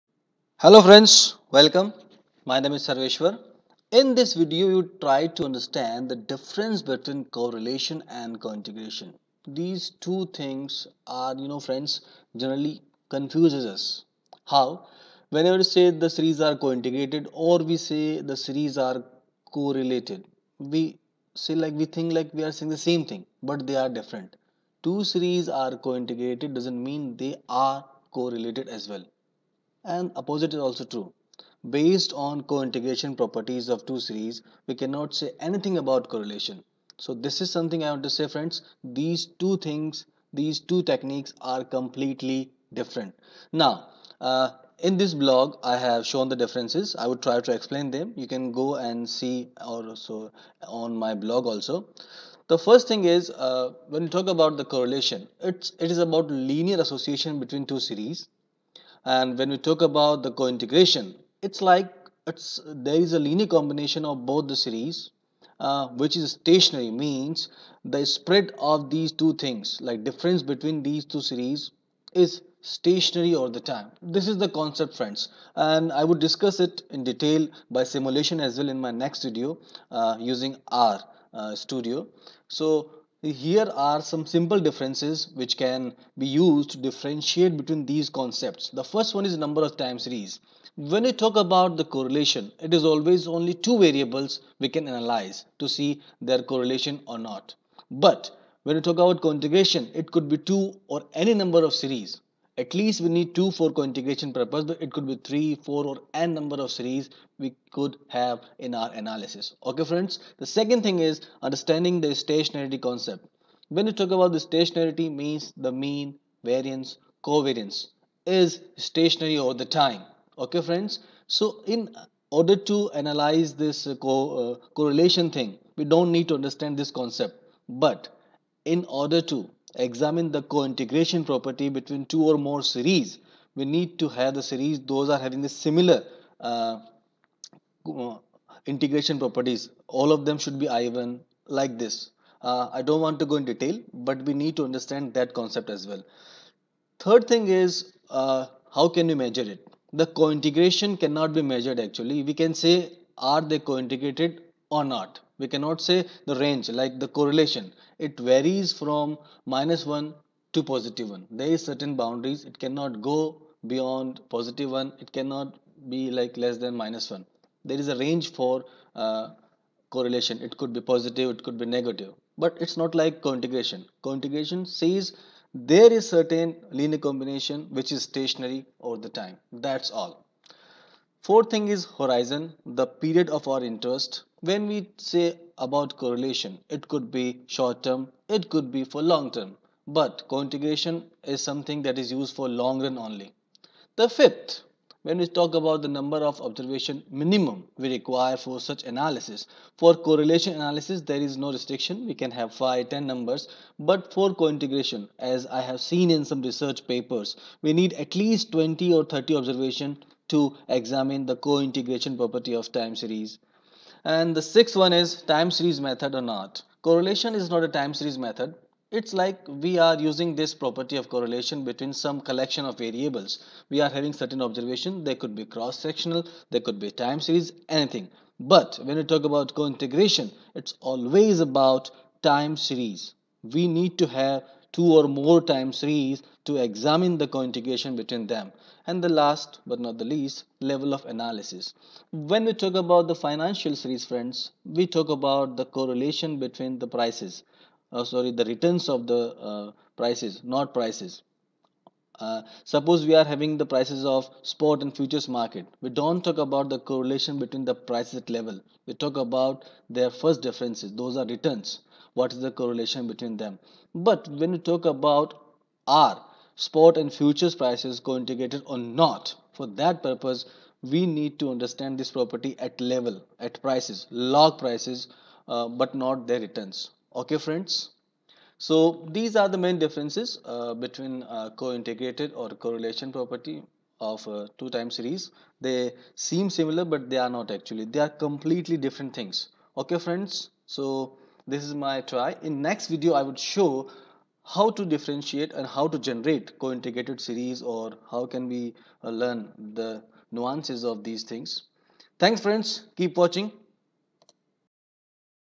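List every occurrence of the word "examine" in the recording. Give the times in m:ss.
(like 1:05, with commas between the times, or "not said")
2:09, 3:30, 3:56.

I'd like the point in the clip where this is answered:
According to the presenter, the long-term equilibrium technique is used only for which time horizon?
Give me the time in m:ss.
3:12.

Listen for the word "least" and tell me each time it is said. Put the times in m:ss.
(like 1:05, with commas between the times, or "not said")
1:42, 3:28, 4:00.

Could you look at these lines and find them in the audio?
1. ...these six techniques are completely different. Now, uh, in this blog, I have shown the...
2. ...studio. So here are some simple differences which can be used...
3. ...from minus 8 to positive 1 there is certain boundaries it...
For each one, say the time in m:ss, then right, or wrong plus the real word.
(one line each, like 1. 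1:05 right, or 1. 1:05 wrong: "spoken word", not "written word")
1. 0:40 wrong: "two", not "six"
2. 1:21 right
3. 2:38 wrong: "1", not "8".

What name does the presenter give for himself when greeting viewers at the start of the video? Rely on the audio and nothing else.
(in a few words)
Sarveshwar.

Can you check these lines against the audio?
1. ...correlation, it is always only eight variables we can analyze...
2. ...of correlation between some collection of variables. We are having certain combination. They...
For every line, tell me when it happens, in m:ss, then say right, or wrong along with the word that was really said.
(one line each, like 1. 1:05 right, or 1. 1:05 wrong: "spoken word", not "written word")
1. 1:31 wrong: "two", not "eight"
2. 3:40 wrong: "observation", not "combination".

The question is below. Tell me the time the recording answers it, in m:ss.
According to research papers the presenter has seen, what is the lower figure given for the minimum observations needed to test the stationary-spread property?
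3:28.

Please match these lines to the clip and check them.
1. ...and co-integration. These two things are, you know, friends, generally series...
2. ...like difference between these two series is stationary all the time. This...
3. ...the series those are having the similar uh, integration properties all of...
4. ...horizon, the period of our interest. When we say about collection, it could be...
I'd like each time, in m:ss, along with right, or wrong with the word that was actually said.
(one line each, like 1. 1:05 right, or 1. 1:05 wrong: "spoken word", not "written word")
1. 0:08 wrong: "confuses", not "series"
2. 1:09 right
3. 2:14 right
4. 3:01 wrong: "correlation", not "collection".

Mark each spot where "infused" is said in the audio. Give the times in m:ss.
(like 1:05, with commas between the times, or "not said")
not said.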